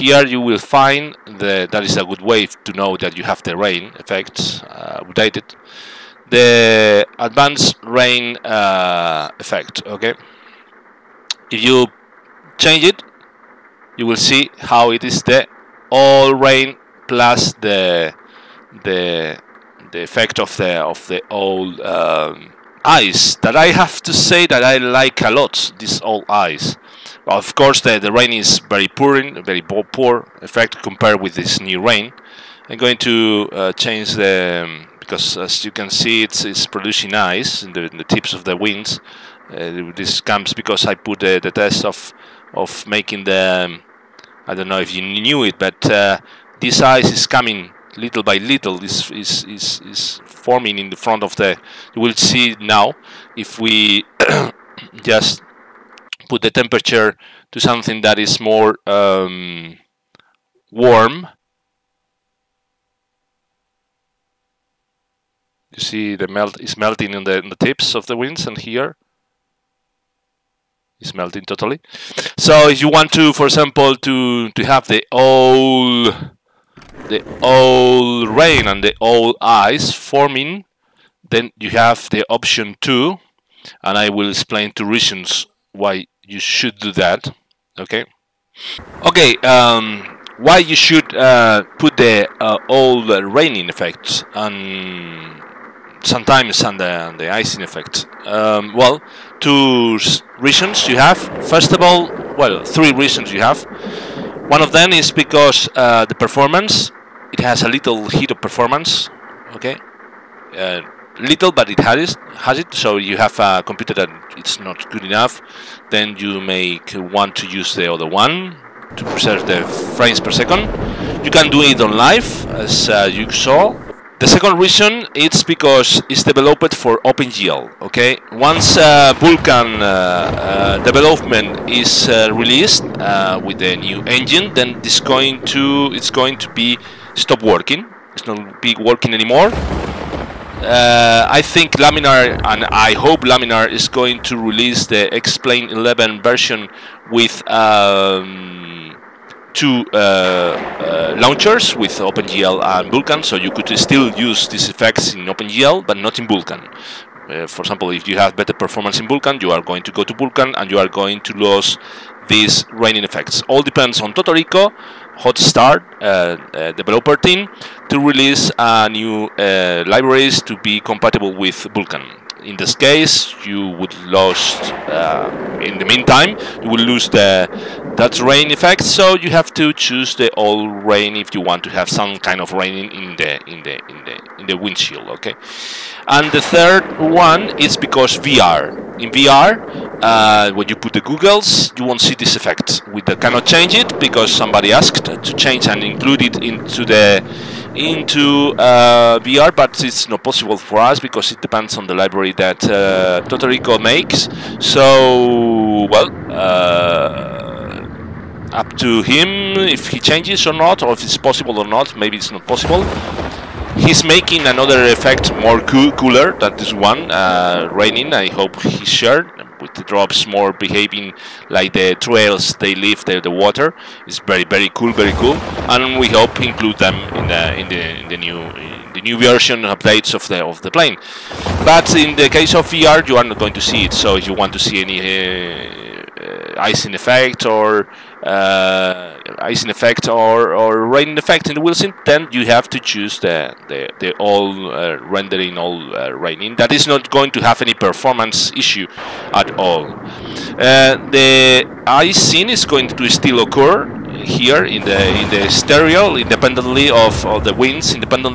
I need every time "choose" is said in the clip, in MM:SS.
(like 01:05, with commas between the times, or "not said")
02:59, 04:02.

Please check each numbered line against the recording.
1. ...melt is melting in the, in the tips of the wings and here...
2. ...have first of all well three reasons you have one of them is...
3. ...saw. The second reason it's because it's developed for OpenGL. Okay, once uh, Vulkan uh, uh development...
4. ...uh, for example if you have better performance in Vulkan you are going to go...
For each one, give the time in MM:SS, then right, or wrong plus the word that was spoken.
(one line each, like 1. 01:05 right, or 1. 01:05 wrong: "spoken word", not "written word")
1. 01:06 right
2. 01:40 right
3. 02:03 right
4. 02:37 right.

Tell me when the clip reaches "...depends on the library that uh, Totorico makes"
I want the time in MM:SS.
03:21.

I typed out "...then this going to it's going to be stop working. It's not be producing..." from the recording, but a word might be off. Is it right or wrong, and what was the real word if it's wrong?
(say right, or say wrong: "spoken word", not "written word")
wrong: "working", not "producing".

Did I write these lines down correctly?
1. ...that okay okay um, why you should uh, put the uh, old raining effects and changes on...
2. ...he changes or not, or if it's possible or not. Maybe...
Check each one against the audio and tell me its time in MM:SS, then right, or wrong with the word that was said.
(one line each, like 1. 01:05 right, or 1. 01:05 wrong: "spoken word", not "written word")
1. 01:26 wrong: "sometimes", not "changes"
2. 03:29 right.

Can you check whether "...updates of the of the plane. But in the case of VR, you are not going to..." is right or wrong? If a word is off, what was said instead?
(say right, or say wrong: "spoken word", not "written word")
right.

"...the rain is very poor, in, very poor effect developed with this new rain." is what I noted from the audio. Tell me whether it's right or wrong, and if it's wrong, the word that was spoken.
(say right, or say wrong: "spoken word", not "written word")
wrong: "compared", not "developed".